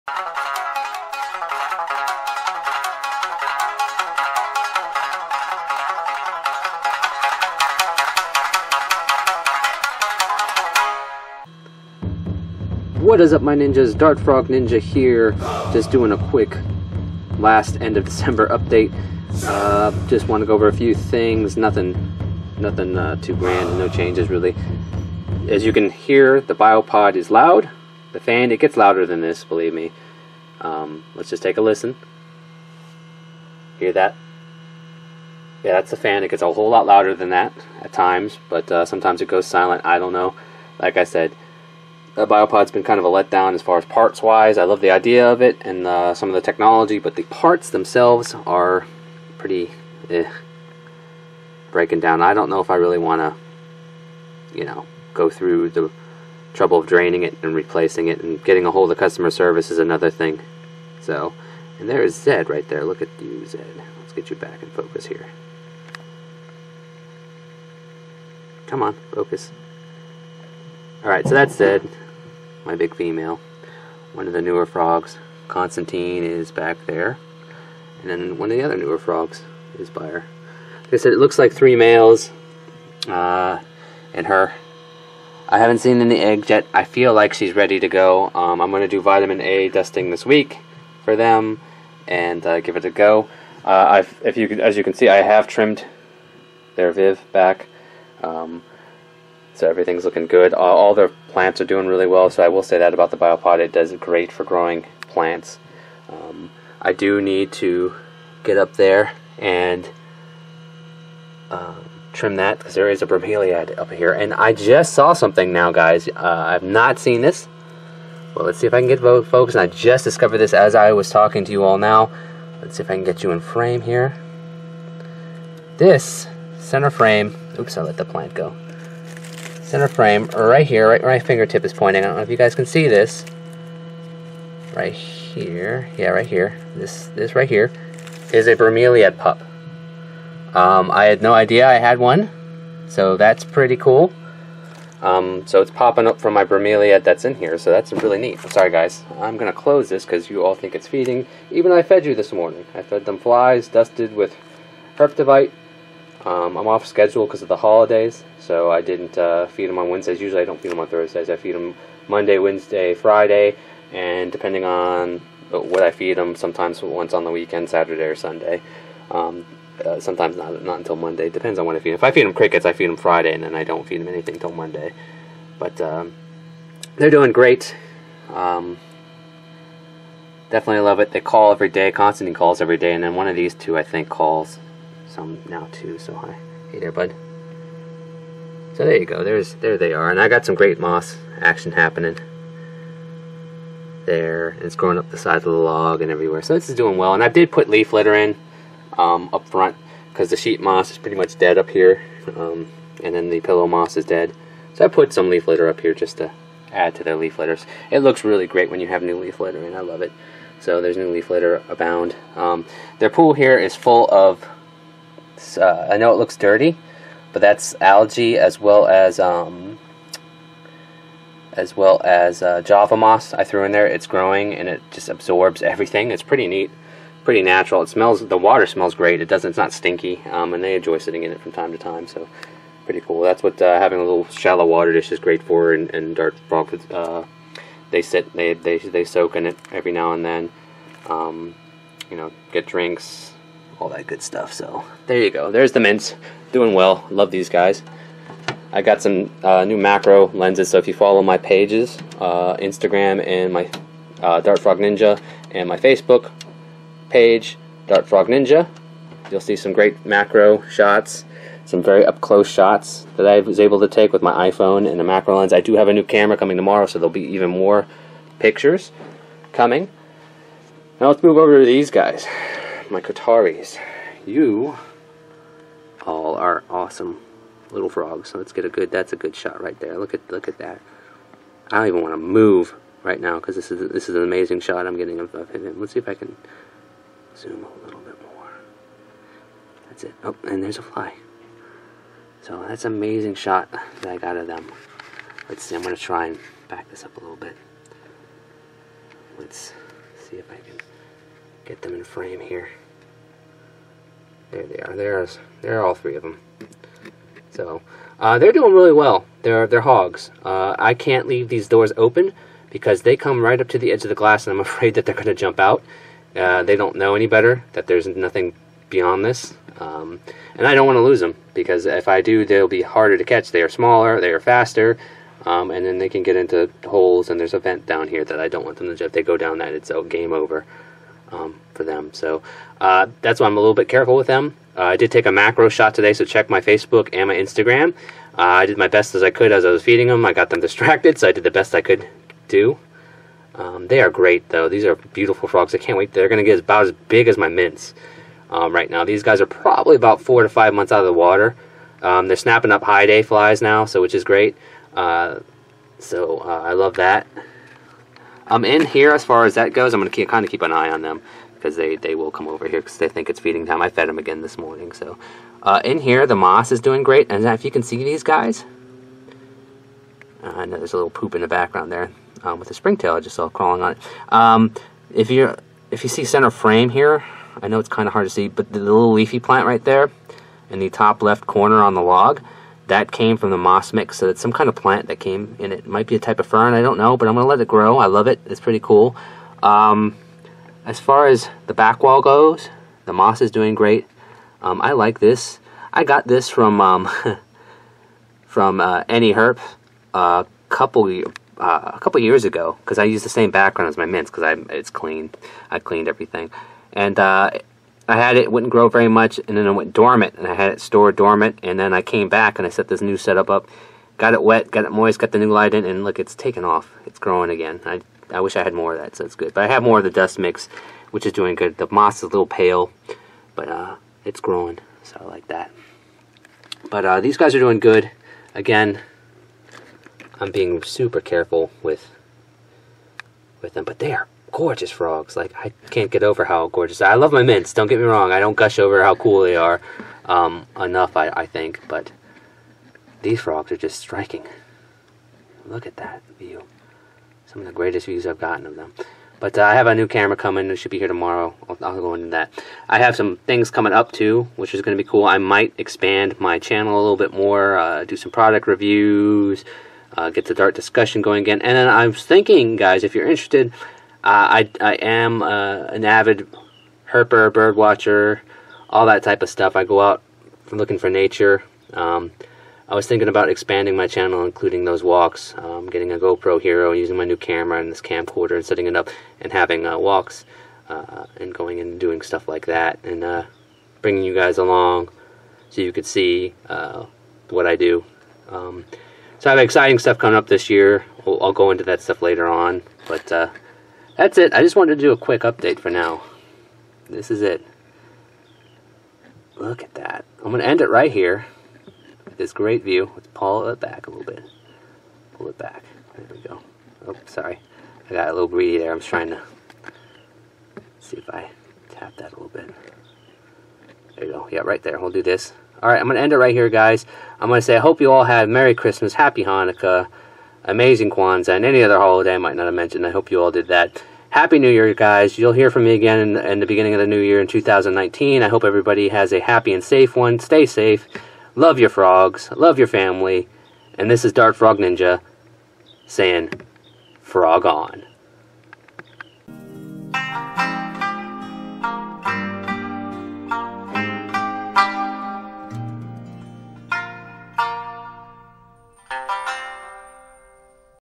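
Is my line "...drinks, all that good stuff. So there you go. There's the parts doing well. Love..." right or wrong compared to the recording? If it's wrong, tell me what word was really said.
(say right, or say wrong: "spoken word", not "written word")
wrong: "mints", not "parts".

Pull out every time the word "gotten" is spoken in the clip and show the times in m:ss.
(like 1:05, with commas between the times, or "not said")
7:28.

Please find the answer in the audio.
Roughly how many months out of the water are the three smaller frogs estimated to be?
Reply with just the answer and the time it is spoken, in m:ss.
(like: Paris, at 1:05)
4 to 5 months, at 5:50.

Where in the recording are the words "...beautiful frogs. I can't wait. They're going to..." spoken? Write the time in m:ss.
5:44.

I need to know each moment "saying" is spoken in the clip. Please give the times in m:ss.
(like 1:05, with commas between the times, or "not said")
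8:56.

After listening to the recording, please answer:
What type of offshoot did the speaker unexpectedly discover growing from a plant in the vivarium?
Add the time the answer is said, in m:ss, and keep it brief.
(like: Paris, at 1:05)
bromeliad pup, at 2:18.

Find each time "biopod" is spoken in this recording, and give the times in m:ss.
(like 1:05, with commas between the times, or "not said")
0:26, 0:42, 1:43.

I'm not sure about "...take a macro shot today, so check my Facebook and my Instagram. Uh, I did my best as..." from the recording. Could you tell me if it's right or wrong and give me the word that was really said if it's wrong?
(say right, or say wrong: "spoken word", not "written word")
right.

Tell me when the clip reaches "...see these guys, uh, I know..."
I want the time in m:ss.
6:07.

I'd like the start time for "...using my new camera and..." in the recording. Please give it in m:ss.
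7:56.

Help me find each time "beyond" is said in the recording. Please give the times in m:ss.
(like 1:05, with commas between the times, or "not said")
5:18.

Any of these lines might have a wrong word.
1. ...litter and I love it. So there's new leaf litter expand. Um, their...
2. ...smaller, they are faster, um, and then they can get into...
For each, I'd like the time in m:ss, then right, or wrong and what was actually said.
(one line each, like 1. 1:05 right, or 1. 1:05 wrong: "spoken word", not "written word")
1. 3:29 wrong: "abound", not "expand"
2. 5:23 right.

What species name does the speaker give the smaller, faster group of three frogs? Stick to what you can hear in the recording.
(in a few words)
Koetaris.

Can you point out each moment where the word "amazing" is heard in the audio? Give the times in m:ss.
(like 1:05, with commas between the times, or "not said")
4:44, 4:52, 8:40.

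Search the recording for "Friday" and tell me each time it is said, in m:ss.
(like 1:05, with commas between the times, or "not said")
2:42, 2:52.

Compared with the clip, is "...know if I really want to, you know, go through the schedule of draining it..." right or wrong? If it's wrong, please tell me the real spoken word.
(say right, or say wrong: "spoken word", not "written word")
wrong: "trouble", not "schedule".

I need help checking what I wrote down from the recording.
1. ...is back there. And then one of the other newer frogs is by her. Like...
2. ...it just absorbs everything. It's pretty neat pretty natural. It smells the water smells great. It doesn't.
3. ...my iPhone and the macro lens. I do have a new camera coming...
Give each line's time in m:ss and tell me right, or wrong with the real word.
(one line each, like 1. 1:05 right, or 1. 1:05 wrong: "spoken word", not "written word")
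1. 1:16 right
2. 3:44 right
3. 4:24 right.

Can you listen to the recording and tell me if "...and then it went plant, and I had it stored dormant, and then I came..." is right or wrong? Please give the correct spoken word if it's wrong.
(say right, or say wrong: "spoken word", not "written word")
wrong: "dormant", not "plant".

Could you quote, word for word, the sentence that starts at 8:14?
I just wanted to do a quick update for now.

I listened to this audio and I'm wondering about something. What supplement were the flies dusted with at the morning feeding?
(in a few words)
Herptivite.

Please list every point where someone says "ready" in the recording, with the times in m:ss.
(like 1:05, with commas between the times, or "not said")
1:27.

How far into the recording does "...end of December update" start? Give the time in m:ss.
0:17.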